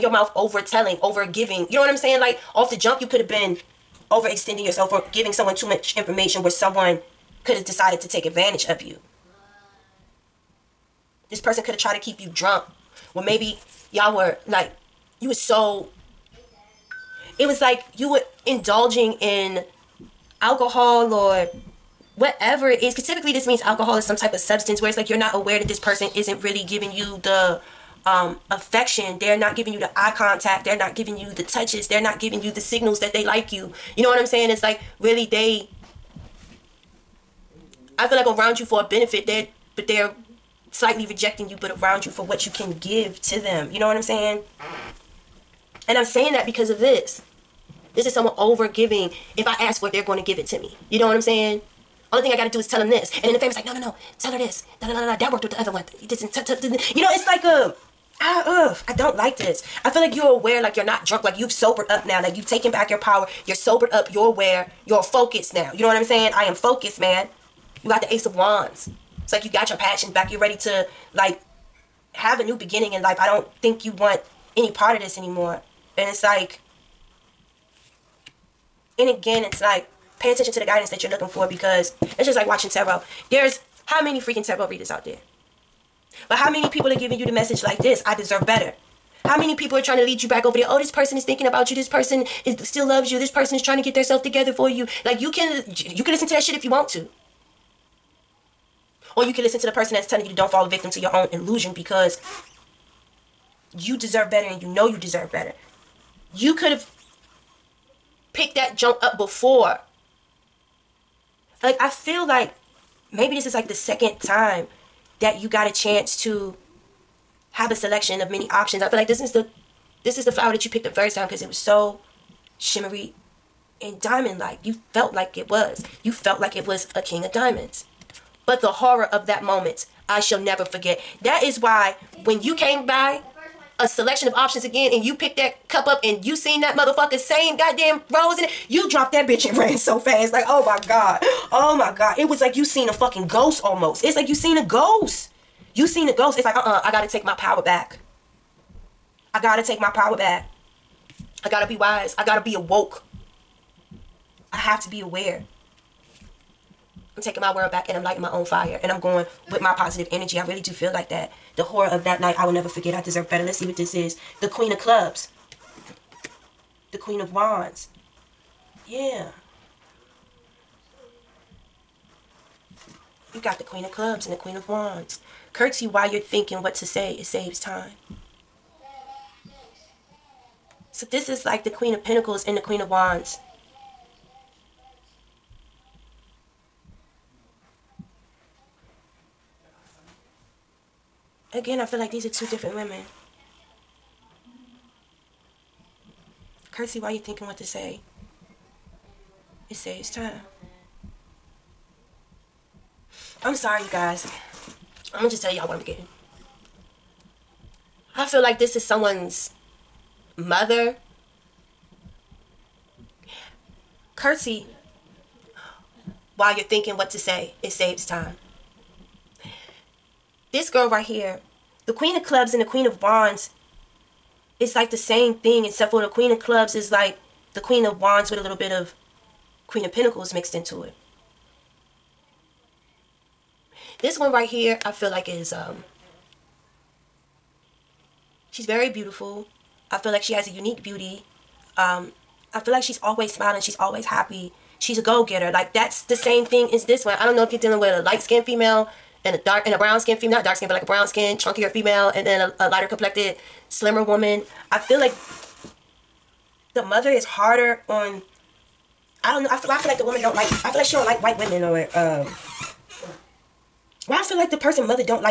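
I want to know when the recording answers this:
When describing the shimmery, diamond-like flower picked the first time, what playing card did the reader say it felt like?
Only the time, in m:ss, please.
2:07.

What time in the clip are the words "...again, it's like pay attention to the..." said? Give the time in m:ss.
1:19.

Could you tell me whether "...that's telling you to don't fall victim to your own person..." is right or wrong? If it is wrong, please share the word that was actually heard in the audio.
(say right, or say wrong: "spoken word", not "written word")
wrong: "illusion", not "person".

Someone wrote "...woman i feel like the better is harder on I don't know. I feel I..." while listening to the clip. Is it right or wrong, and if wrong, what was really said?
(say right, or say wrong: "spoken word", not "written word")
wrong: "mother", not "better".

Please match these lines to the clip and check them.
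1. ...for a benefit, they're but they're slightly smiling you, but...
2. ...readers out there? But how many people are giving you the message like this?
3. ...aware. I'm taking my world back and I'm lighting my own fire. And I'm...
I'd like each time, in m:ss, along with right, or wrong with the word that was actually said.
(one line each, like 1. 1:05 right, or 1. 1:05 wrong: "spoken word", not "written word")
1. 0:38 wrong: "rejecting", not "smiling"
2. 1:24 right
3. 2:35 right.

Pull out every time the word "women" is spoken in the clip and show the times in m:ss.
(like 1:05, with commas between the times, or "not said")
3:12, 4:21.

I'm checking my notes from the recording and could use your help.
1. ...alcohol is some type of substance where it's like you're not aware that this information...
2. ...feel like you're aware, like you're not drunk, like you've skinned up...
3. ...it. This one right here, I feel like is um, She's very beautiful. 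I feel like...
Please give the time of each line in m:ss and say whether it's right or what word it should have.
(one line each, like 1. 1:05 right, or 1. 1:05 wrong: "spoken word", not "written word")
1. 0:23 wrong: "person", not "information"
2. 0:59 wrong: "sobered", not "skinned"
3. 3:50 right.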